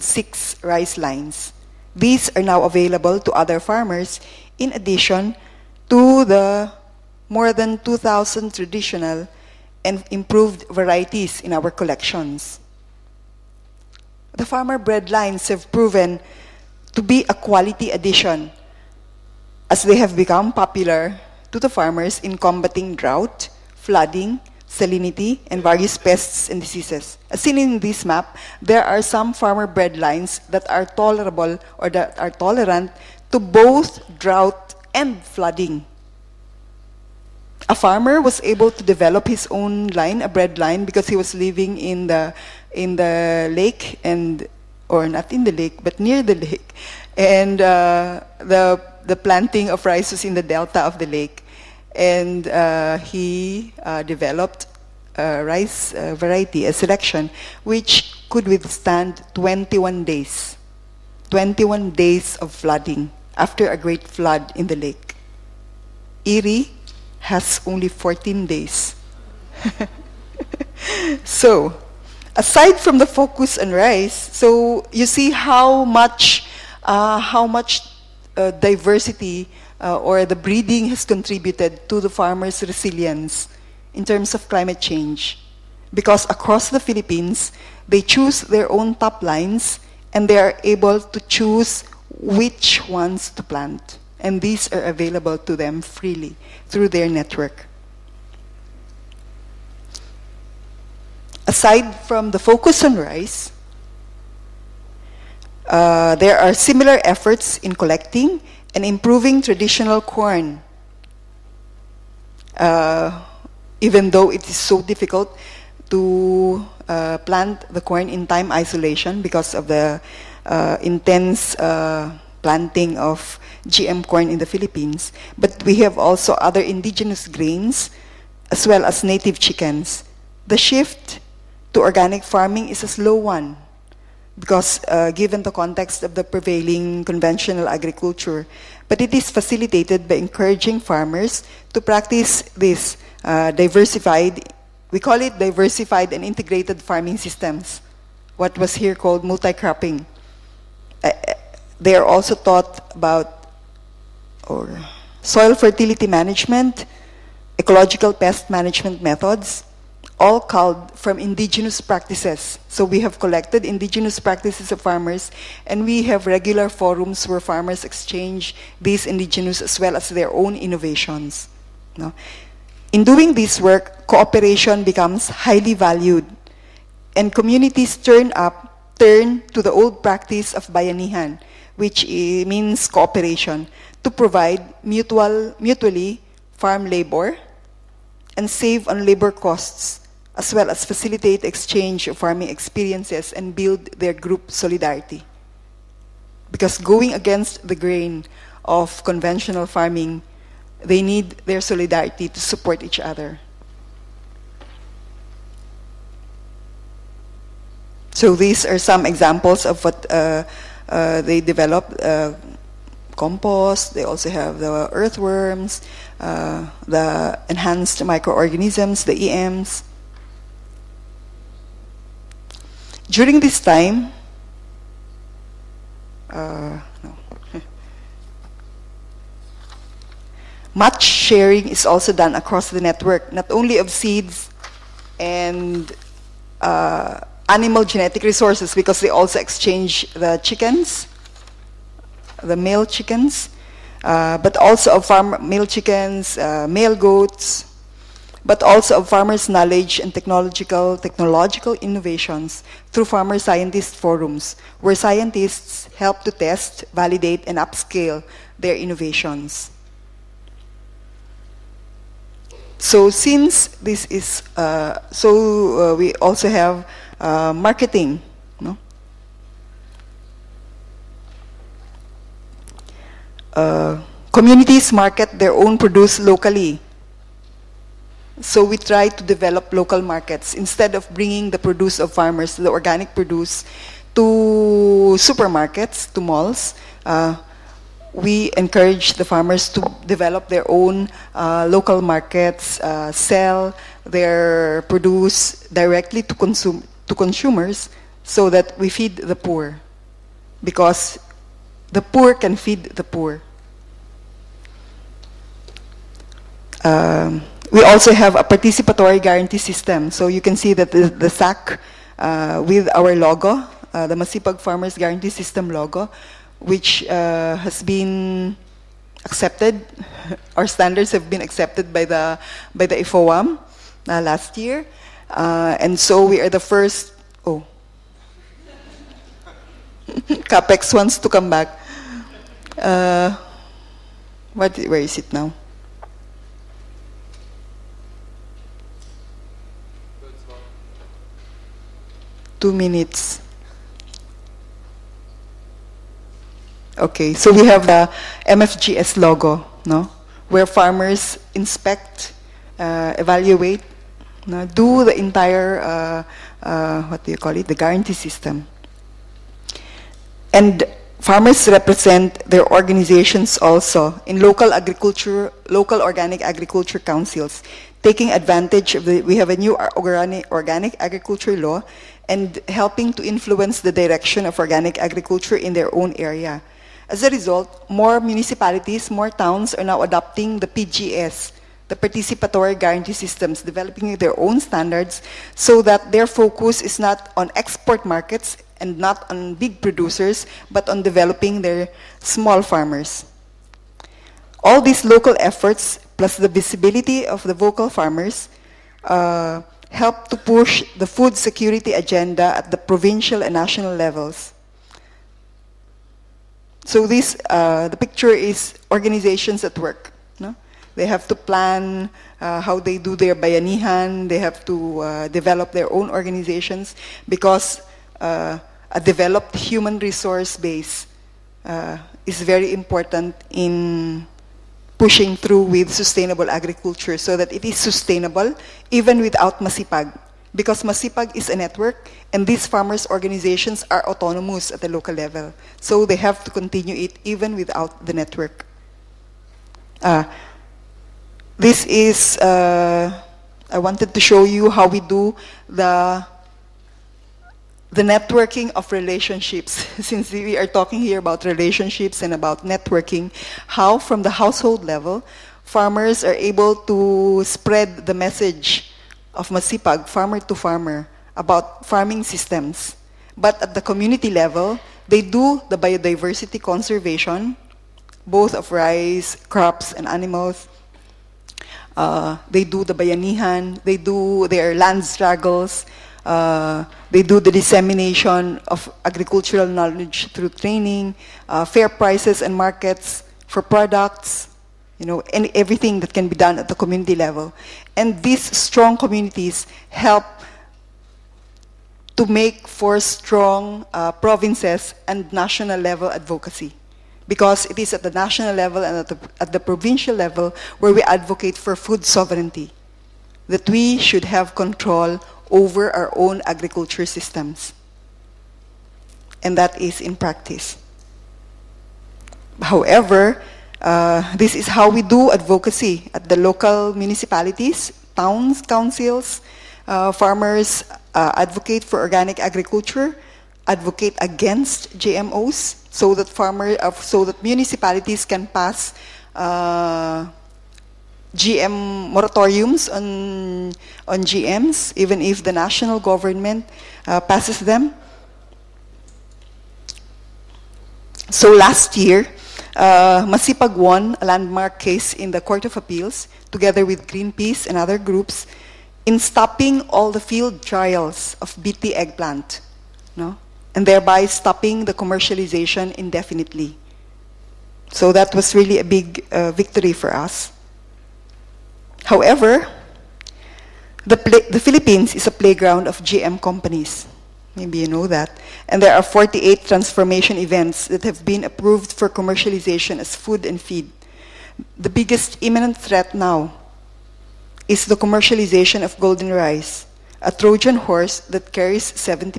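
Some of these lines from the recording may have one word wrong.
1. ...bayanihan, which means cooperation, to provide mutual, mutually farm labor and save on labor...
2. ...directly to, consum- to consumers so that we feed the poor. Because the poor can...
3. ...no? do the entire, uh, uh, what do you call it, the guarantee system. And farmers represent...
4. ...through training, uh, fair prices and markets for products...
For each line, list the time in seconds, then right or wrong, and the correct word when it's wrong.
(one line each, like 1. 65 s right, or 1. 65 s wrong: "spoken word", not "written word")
1. 180 s right
2. 295 s right
3. 354 s right
4. 480 s right.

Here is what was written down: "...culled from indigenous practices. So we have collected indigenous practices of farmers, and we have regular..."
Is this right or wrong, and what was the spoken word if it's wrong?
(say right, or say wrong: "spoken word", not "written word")
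right.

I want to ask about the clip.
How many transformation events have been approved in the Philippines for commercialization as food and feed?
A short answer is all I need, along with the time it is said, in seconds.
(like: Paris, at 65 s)
48, at 569 s.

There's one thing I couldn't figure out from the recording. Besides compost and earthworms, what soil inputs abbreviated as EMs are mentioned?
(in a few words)
enhanced microorganisms.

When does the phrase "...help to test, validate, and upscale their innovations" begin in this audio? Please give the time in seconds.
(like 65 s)
255 s.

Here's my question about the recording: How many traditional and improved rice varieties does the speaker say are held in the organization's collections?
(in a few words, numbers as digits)
more than 2,000.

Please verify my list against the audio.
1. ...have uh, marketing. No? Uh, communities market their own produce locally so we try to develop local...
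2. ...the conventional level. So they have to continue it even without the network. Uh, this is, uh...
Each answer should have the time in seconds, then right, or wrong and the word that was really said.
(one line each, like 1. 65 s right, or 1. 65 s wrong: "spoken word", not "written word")
1. 266 s right
2. 434 s wrong: "local", not "conventional".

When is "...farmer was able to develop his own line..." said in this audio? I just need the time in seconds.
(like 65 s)
37 s.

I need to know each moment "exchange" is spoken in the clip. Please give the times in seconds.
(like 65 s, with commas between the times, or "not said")
167 s, 191 s, 239 s.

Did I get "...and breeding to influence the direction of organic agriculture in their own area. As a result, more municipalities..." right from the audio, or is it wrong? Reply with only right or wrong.
wrong.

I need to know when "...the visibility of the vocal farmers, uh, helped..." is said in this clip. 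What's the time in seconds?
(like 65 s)
396 s.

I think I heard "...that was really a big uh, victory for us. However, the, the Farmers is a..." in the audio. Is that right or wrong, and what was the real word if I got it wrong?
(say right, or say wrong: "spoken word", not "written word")
wrong: "Philippines", not "Farmers".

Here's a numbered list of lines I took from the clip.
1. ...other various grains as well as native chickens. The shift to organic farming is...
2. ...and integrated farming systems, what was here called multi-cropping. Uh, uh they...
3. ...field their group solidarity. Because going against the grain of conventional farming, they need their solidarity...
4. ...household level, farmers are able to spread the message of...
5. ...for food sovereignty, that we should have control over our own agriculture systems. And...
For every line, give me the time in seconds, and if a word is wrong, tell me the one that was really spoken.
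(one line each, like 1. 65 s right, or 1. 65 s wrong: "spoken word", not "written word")
1. 126 s wrong: "indigenous", not "various"
2. 146 s right
3. 193 s wrong: "build", not "field"
4. 454 s right
5. 501 s right.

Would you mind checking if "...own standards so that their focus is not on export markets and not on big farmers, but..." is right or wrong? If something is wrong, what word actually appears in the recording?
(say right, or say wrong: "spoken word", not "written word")
wrong: "producers", not "farmers".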